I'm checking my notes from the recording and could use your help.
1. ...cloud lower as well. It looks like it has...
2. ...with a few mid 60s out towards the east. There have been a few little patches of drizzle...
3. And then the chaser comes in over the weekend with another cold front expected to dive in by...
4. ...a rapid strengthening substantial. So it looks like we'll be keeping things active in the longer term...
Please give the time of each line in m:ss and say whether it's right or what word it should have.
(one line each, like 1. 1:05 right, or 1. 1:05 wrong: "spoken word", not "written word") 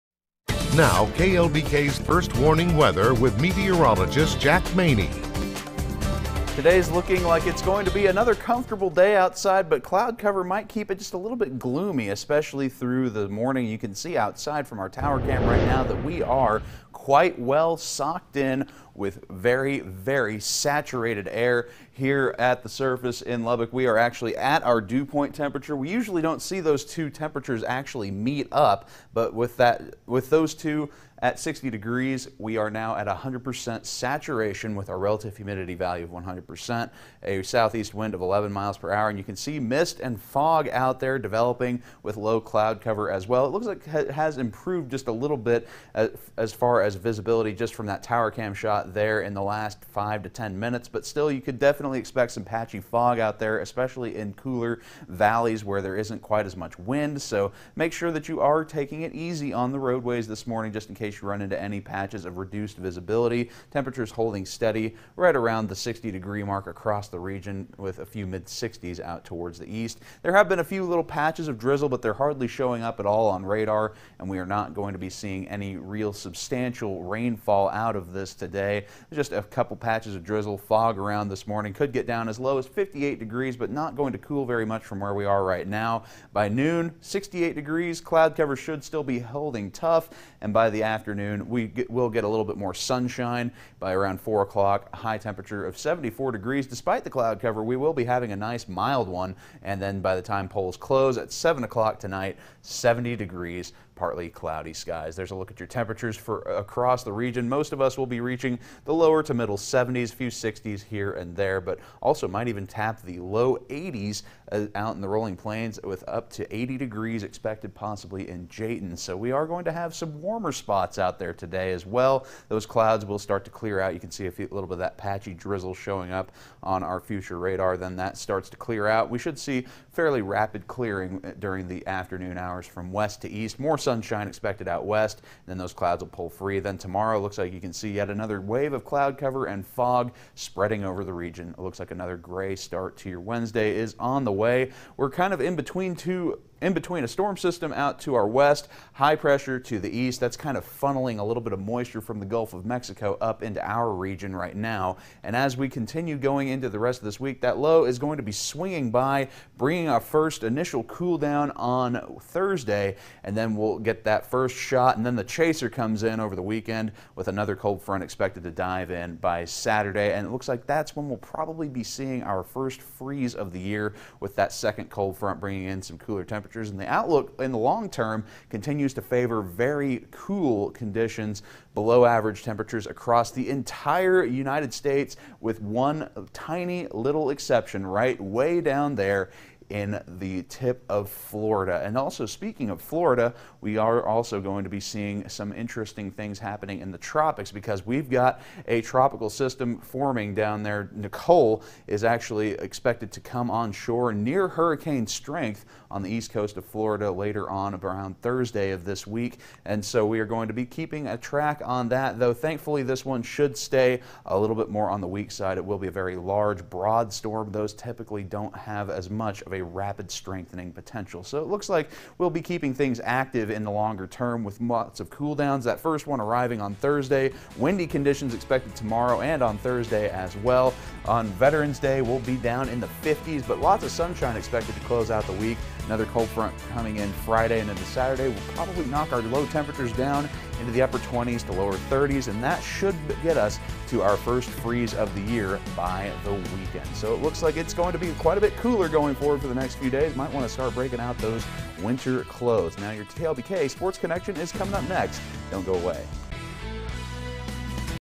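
1. 0:42 wrong: "cover", not "lower"
2. 1:07 right
3. 2:44 right
4. 3:39 wrong: "potential", not "substantial".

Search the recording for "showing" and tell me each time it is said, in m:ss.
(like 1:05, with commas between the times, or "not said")
1:12, 2:05.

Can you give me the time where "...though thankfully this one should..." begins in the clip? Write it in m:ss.
3:32.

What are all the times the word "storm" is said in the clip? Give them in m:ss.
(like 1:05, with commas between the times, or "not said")
2:27, 3:37.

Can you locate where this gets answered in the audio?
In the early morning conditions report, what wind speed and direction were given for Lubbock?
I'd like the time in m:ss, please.
0:37.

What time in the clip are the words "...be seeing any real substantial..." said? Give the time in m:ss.
1:14.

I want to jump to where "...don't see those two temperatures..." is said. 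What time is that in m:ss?
0:26.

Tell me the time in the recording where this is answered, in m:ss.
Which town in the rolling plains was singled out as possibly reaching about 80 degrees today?
1:58.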